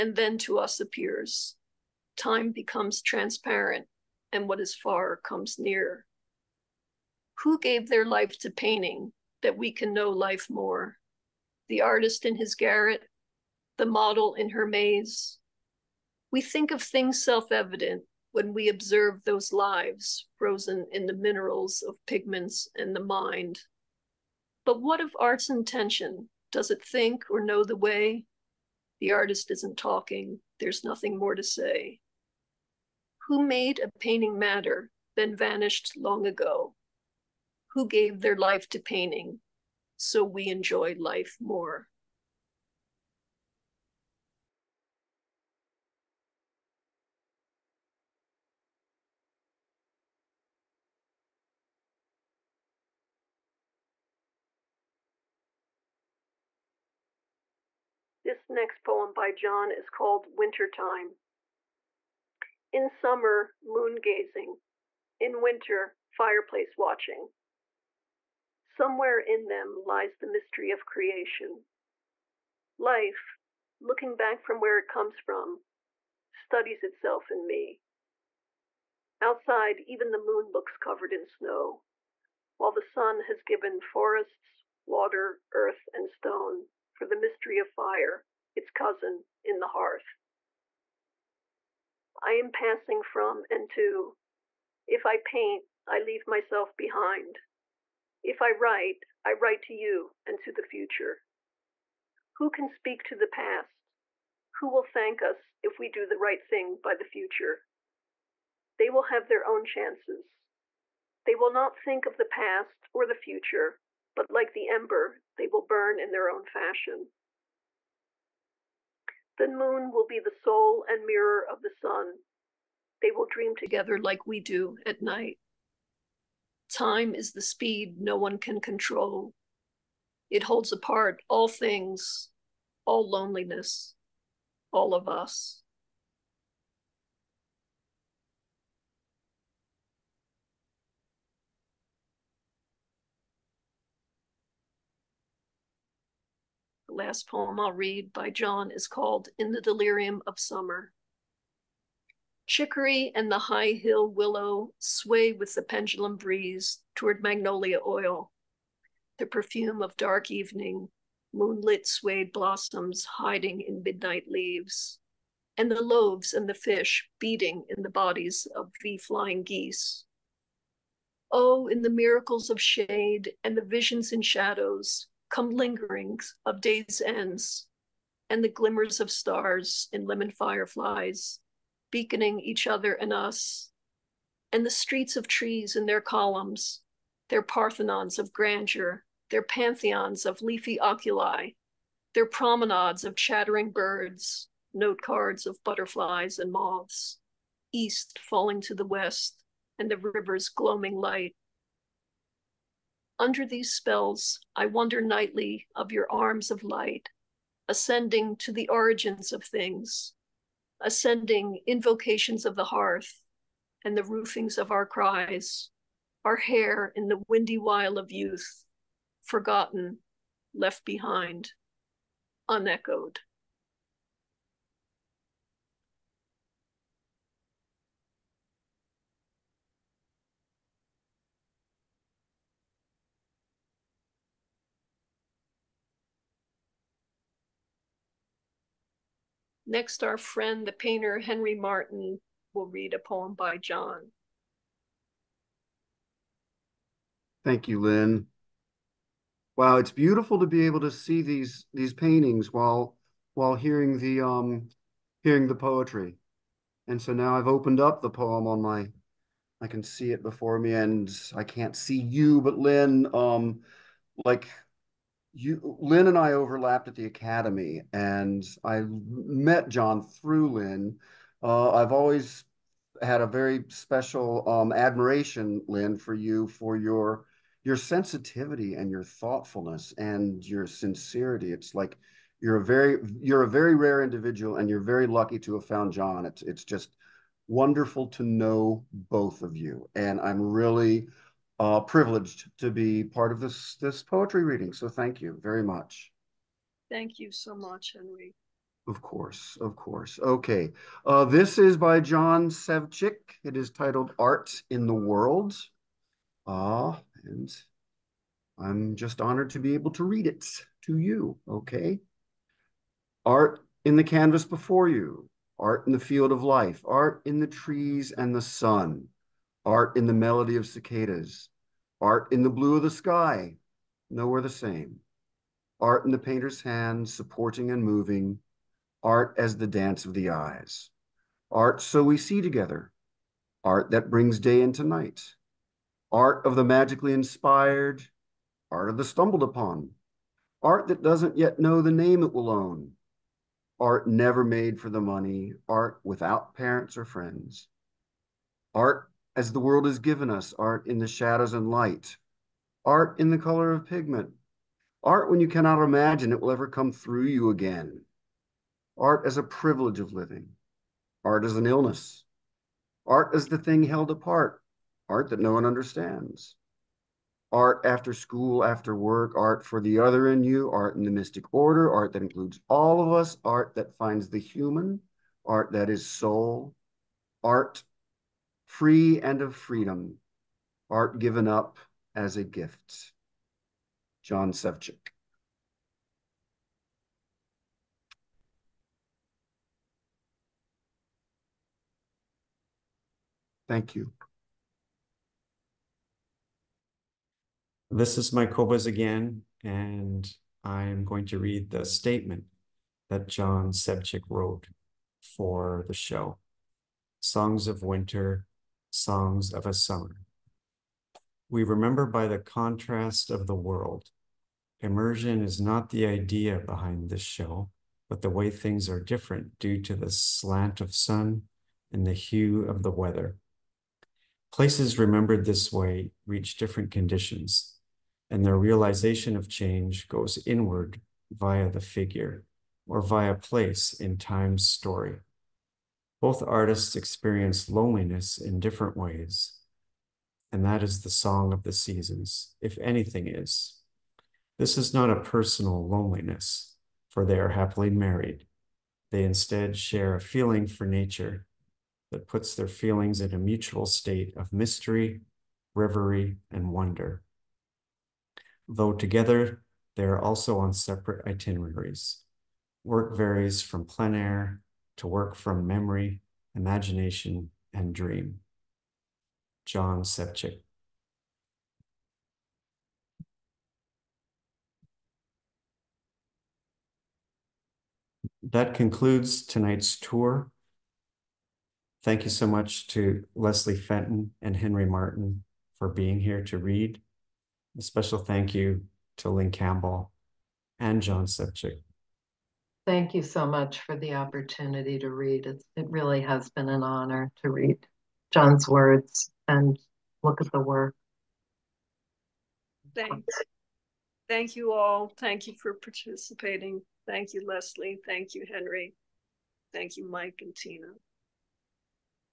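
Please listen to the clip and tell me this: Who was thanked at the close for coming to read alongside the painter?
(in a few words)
Leslie Fenton.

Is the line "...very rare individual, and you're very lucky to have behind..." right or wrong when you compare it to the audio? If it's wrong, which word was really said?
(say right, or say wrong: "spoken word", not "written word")
wrong: "found", not "behind".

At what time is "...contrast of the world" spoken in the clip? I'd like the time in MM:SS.
06:52.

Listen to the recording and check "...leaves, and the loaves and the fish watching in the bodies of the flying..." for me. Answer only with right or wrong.
wrong.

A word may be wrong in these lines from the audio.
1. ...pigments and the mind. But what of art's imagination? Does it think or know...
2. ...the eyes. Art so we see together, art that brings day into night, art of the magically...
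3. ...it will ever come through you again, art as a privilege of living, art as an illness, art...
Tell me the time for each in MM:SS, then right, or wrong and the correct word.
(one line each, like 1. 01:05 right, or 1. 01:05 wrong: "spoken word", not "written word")
1. 00:22 wrong: "intention", not "imagination"
2. 05:30 right
3. 05:56 right.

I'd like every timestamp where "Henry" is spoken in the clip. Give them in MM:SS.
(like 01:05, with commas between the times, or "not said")
04:01, 04:57, 08:04, 08:28.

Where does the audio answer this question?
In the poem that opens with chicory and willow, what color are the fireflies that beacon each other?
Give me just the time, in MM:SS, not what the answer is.
03:00.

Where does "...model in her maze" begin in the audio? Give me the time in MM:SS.
00:13.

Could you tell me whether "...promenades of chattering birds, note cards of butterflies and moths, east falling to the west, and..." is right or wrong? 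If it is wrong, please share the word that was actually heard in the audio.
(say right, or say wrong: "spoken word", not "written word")
right.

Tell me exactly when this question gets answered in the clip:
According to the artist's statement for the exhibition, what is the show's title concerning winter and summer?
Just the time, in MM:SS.
06:47.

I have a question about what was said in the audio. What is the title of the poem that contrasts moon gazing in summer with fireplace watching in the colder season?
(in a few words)
Wintertime.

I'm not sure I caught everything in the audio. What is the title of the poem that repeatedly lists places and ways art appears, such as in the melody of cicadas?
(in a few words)
Art in the World.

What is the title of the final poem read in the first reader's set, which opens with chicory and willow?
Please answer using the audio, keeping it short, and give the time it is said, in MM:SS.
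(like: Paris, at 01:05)
In the Delirium of Summer, at 02:29.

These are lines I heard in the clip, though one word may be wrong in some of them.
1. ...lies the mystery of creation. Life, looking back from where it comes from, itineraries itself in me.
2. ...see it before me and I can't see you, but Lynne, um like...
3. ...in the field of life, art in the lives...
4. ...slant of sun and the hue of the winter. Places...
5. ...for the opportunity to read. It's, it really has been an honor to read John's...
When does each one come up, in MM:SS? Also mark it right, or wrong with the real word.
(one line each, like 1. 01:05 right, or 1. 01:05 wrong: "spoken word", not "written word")
1. 01:09 wrong: "studies", not "itineraries"
2. 04:19 right
3. 05:15 wrong: "trees", not "lives"
4. 07:00 wrong: "weather", not "winter"
5. 08:13 right.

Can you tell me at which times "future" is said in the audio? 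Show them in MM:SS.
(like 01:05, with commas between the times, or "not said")
01:40, 01:47, 01:53.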